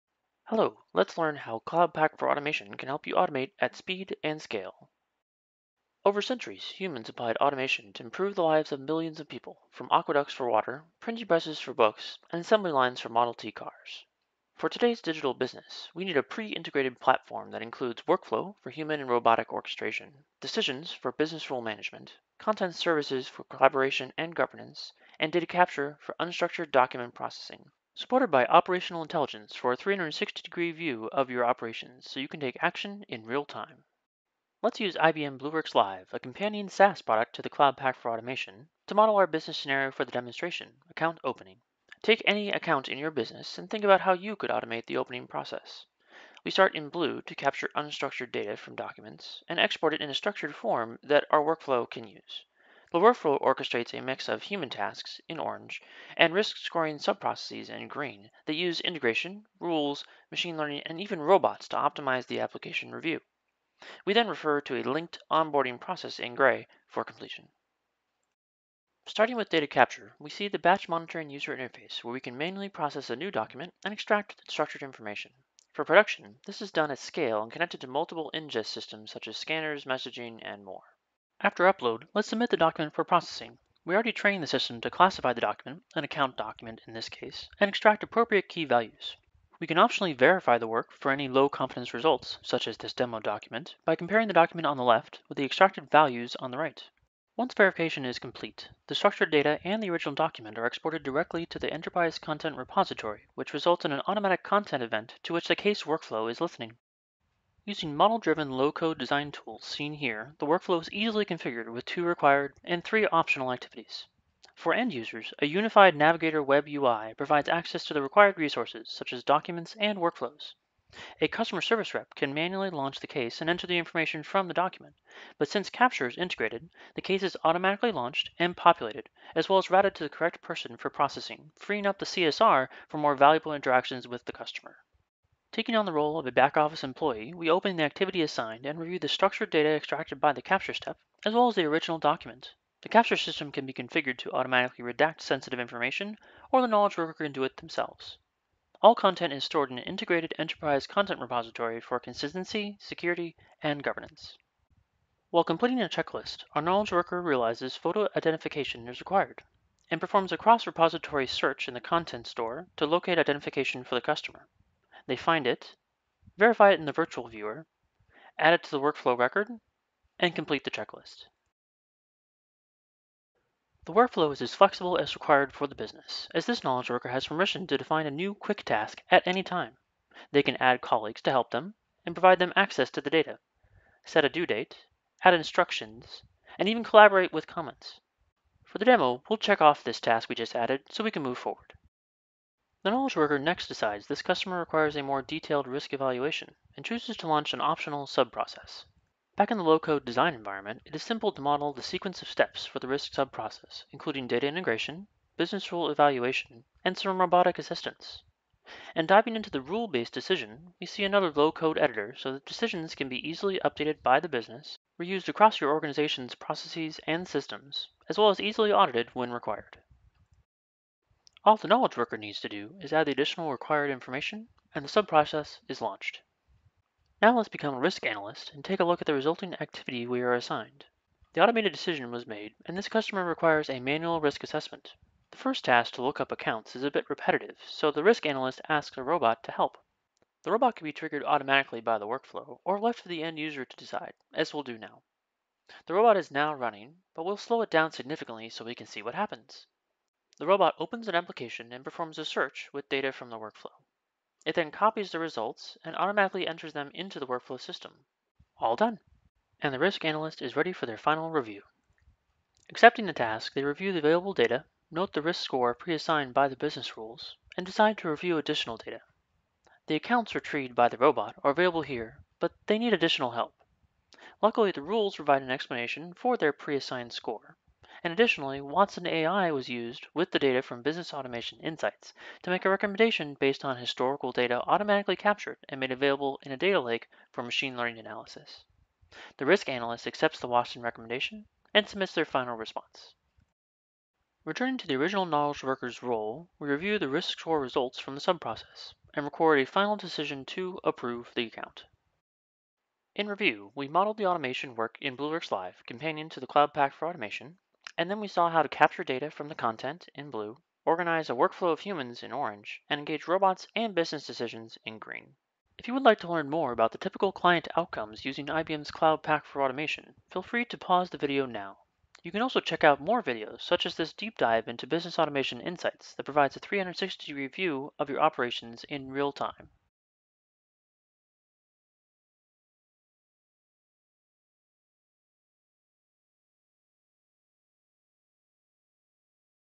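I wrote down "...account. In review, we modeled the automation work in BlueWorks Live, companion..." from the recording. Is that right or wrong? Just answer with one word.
right.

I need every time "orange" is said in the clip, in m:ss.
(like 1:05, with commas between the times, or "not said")
0:55, 5:12.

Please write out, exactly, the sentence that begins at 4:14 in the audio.
It then copies the results and automatically enters them into the workflow system.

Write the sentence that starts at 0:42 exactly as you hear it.
Take any account in your business and think about how you could automate the opening process.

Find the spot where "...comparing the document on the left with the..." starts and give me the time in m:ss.
1:33.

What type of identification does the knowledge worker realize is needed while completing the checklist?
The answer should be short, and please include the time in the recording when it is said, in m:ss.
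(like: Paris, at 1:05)
Photo identification, at 2:37.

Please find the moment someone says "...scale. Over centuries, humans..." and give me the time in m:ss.
0:04.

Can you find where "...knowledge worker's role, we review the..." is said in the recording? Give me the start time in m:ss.
4:55.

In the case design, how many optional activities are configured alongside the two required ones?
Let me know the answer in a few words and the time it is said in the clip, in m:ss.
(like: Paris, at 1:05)
3, at 1:52.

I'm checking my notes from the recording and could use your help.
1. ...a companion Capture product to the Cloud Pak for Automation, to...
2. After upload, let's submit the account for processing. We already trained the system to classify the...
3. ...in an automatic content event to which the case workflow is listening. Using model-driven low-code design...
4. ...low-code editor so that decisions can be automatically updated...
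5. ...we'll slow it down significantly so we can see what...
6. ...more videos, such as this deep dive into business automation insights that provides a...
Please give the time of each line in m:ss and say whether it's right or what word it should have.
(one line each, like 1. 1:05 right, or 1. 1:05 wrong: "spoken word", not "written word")
1. 0:36 wrong: "SaaS", not "Capture"
2. 1:21 wrong: "document", not "account"
3. 1:43 right
4. 3:31 wrong: "easily", not "automatically"
5. 4:07 right
6. 5:23 right.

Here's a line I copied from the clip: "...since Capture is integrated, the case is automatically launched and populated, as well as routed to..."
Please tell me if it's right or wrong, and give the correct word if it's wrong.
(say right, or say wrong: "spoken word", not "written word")
right.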